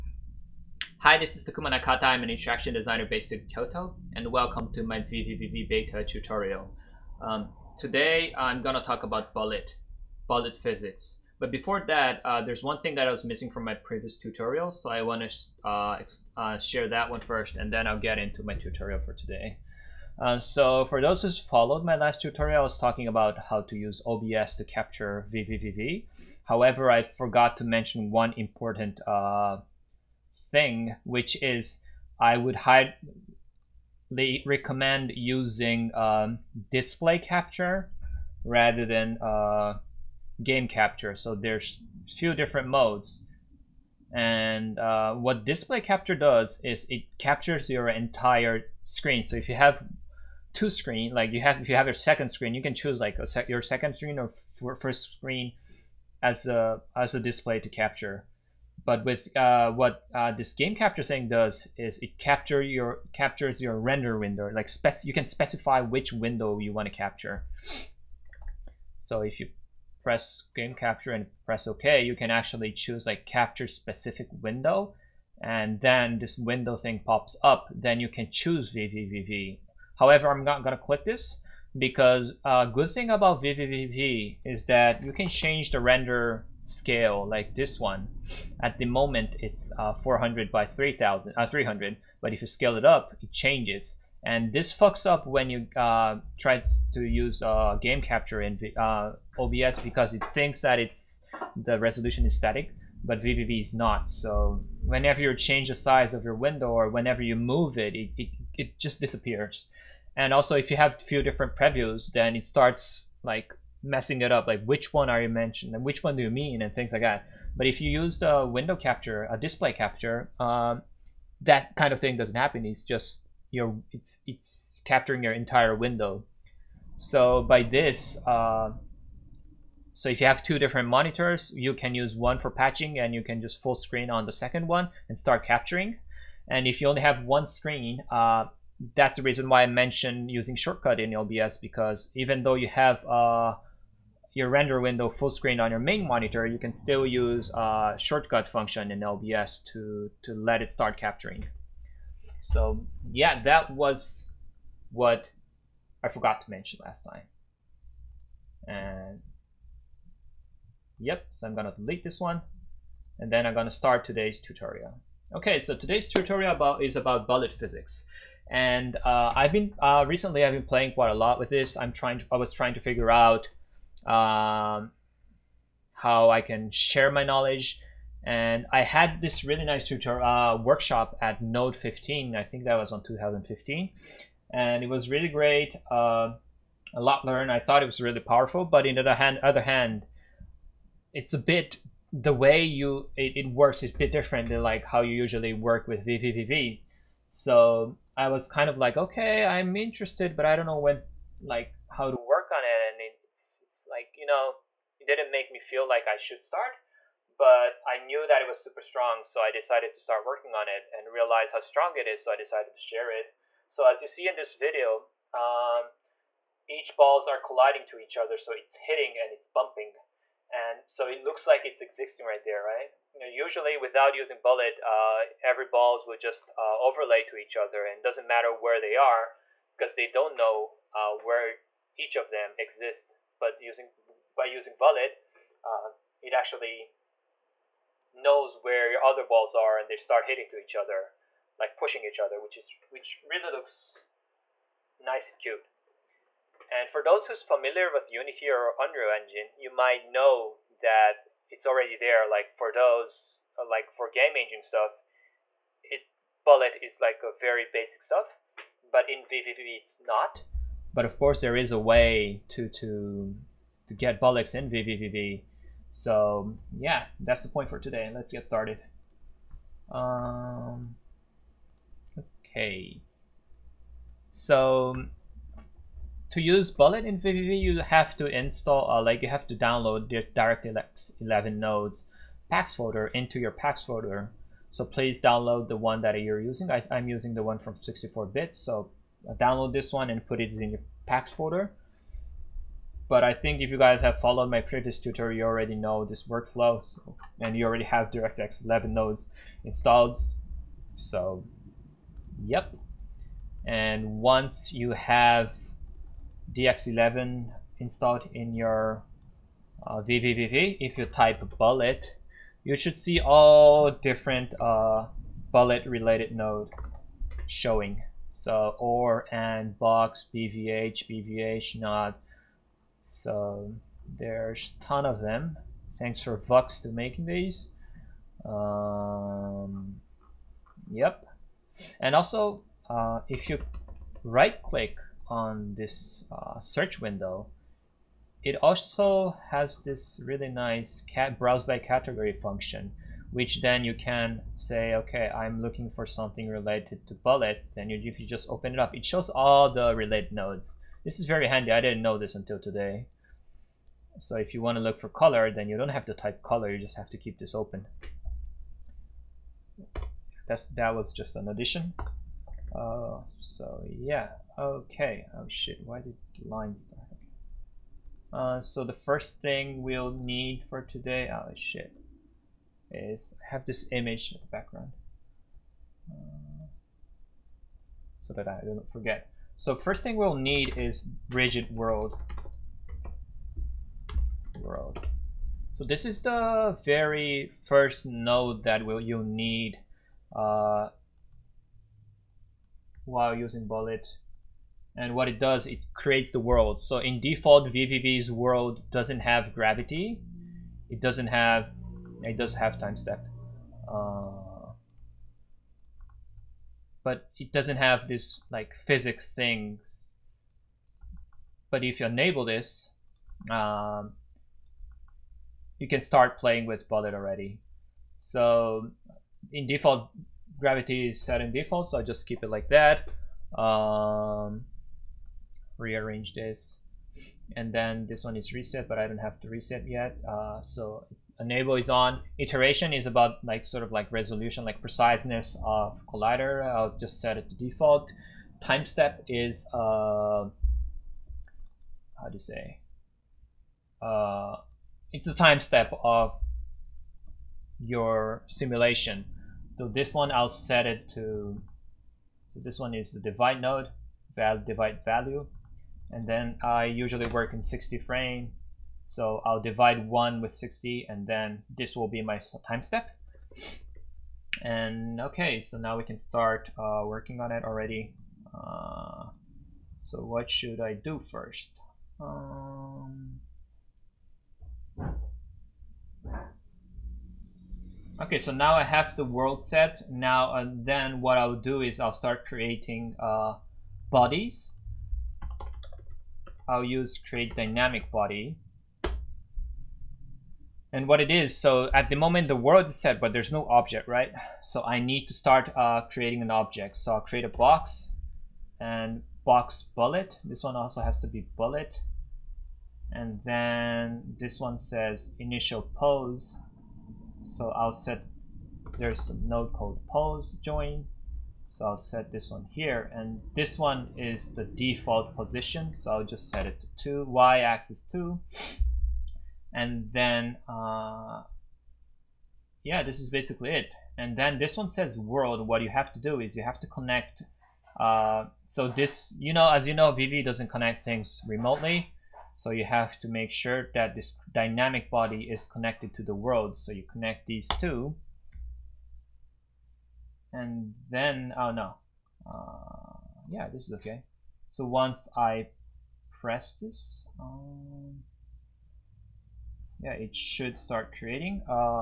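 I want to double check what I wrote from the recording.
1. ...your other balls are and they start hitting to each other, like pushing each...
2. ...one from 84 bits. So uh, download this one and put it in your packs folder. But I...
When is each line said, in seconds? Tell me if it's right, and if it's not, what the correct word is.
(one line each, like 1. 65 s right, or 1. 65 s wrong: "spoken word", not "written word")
1. 238 s right
2. 287 s wrong: "64", not "84".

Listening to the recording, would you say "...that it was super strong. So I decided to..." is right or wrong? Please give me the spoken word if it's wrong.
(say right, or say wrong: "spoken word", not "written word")
right.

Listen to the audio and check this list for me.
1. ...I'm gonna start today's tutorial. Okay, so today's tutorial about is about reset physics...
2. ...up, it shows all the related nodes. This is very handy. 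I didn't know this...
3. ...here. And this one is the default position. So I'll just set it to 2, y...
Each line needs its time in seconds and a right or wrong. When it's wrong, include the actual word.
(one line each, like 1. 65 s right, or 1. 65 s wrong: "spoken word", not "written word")
1. 163 s wrong: "bullet", not "reset"
2. 348 s right
3. 512 s right.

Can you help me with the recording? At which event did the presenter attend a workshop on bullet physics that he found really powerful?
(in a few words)
Node 15.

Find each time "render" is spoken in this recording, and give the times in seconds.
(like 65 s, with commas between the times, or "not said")
63 s, 85 s, 144 s.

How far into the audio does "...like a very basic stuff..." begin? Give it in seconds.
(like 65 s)
257 s.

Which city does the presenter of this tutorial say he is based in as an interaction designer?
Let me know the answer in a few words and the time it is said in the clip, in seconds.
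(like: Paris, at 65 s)
Kyoto, at 3 s.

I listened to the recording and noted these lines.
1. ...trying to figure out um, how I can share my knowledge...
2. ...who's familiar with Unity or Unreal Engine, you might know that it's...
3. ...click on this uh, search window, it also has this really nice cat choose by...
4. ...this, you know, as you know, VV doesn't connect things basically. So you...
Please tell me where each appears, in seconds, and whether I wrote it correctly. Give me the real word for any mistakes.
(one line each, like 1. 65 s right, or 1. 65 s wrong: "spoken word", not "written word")
1. 172 s right
2. 247 s right
3. 334 s wrong: "browse", not "choose"
4. 528 s wrong: "remotely", not "basically".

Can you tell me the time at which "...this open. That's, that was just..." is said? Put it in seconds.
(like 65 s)
357 s.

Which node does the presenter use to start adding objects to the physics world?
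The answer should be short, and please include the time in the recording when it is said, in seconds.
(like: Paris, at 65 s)
Create dynamic body, at 487 s.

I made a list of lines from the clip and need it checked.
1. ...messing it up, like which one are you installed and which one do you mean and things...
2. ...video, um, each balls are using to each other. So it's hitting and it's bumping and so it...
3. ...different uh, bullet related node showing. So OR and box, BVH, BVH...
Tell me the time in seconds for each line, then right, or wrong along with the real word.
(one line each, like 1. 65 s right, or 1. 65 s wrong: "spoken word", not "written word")
1. 113 s wrong: "mentioned", not "installed"
2. 214 s wrong: "colliding", not "using"
3. 313 s right.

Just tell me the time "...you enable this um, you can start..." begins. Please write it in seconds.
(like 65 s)
412 s.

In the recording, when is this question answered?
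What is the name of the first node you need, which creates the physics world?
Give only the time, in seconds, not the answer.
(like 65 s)
381 s.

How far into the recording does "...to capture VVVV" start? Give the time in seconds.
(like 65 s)
24 s.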